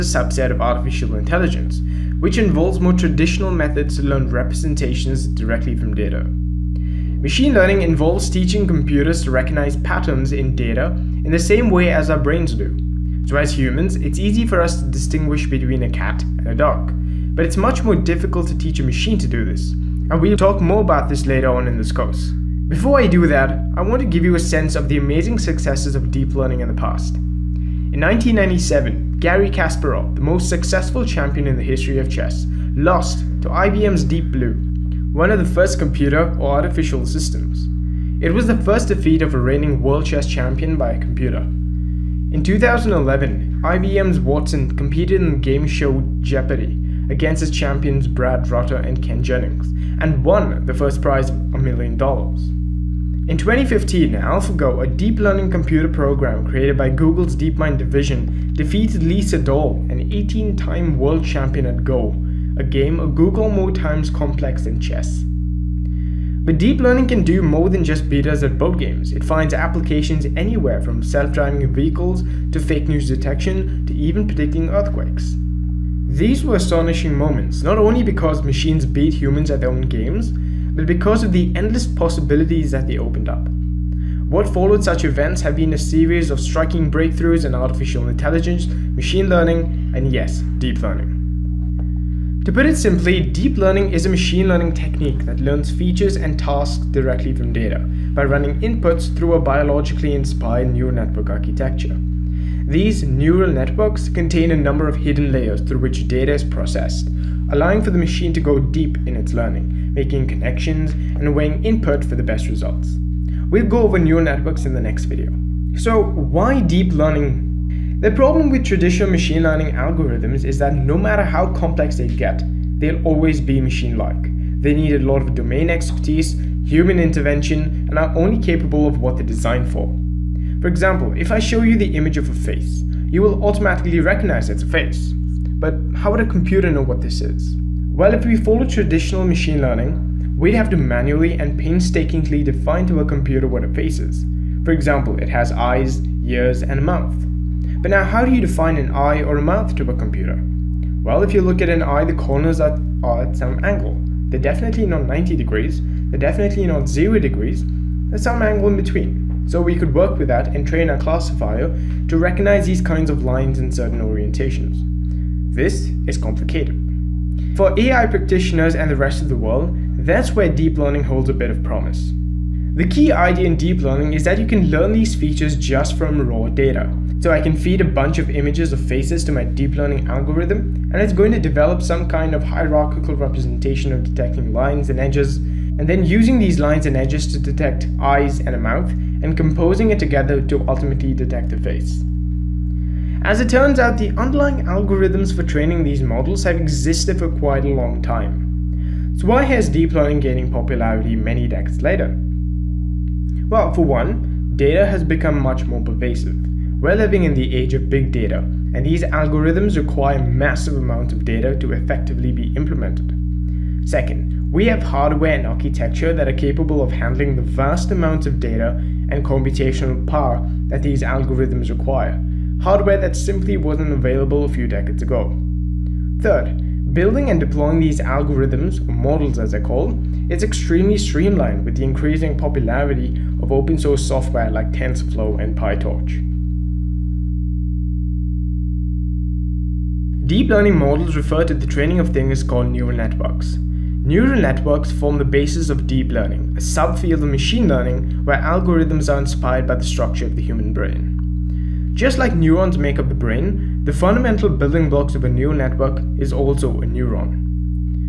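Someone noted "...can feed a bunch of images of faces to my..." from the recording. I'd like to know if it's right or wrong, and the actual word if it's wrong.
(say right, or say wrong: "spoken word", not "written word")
right.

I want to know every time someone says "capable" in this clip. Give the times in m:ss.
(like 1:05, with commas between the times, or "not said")
2:08, 3:36.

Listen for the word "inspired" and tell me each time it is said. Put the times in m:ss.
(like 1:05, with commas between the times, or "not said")
1:40, 4:09.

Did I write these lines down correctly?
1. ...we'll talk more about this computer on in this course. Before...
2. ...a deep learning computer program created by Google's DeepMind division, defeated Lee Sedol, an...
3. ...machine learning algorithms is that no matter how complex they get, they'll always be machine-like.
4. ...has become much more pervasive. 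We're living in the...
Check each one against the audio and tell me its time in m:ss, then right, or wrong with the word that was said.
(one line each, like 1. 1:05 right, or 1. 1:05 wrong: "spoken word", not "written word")
1. 0:20 wrong: "later", not "computer"
2. 0:54 right
3. 1:59 right
4. 3:24 right.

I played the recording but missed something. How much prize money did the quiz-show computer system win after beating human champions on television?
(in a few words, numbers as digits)
a million dollars.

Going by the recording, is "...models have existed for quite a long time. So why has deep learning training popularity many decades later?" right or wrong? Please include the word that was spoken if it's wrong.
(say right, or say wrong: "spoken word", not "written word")
wrong: "gaining", not "training".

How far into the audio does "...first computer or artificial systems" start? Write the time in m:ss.
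0:35.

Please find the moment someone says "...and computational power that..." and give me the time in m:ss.
3:39.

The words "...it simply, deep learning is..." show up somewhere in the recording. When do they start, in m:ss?
1:32.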